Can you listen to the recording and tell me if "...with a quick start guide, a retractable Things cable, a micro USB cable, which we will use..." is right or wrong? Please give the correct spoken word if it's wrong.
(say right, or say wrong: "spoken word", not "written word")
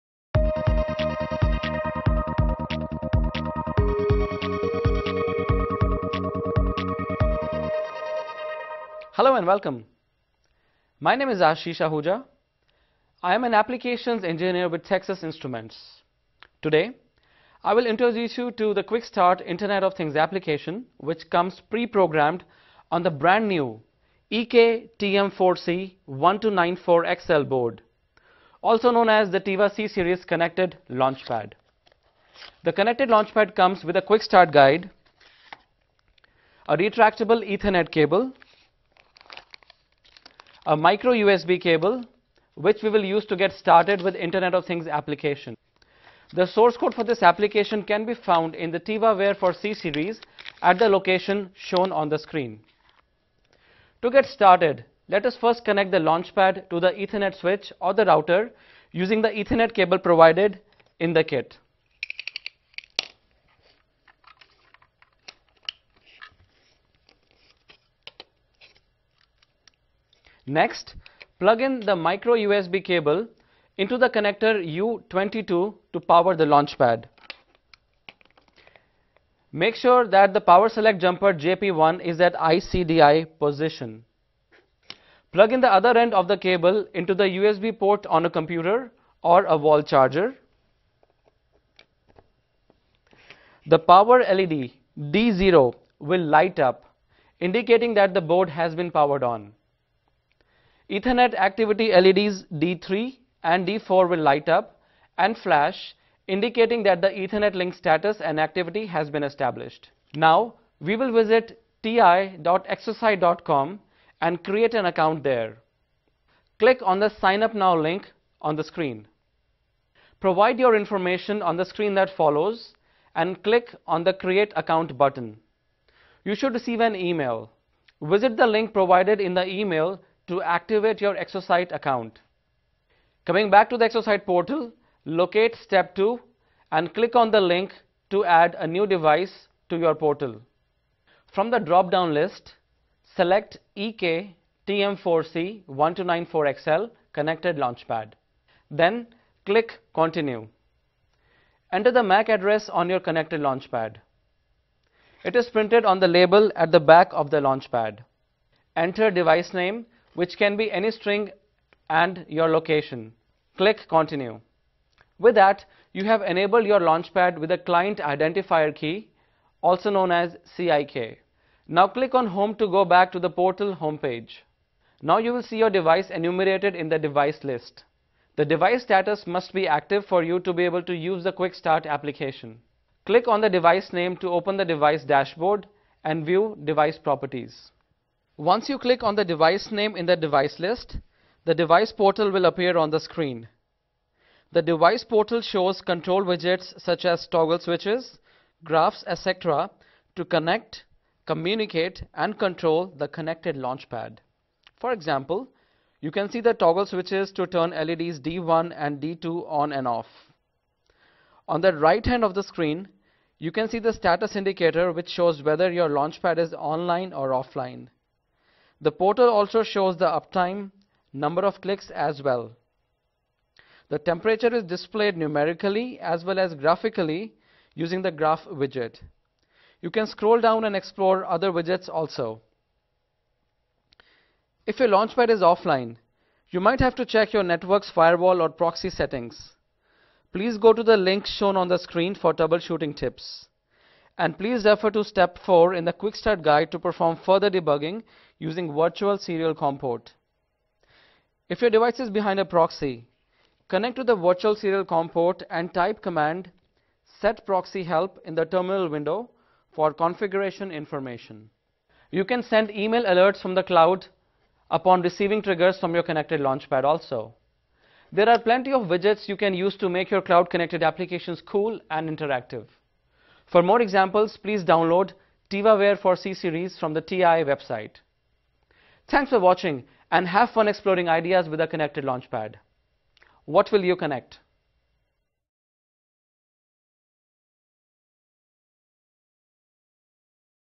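wrong: "Ethernet", not "Things".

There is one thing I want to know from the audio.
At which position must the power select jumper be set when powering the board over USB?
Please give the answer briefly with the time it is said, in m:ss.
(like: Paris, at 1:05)
ICDI, at 1:22.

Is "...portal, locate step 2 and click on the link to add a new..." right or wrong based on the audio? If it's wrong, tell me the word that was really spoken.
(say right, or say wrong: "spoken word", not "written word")
right.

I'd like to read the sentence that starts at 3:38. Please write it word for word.
The portal also shows the uptime, number of clicks as well.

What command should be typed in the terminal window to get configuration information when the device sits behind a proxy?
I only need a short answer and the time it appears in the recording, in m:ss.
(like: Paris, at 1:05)
set proxy help, at 4:17.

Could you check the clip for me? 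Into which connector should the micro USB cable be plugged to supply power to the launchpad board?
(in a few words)
U22.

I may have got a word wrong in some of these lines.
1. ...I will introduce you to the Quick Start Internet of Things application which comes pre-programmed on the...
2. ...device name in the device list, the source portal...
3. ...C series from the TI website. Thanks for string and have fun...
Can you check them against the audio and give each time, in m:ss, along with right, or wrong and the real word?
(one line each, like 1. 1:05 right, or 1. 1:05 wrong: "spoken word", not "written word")
1. 0:17 right
2. 3:09 wrong: "device", not "source"
3. 4:36 wrong: "watching", not "string".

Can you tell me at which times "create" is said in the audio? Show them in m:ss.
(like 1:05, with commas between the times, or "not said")
1:54, 2:04.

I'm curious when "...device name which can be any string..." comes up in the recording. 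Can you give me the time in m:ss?
2:39.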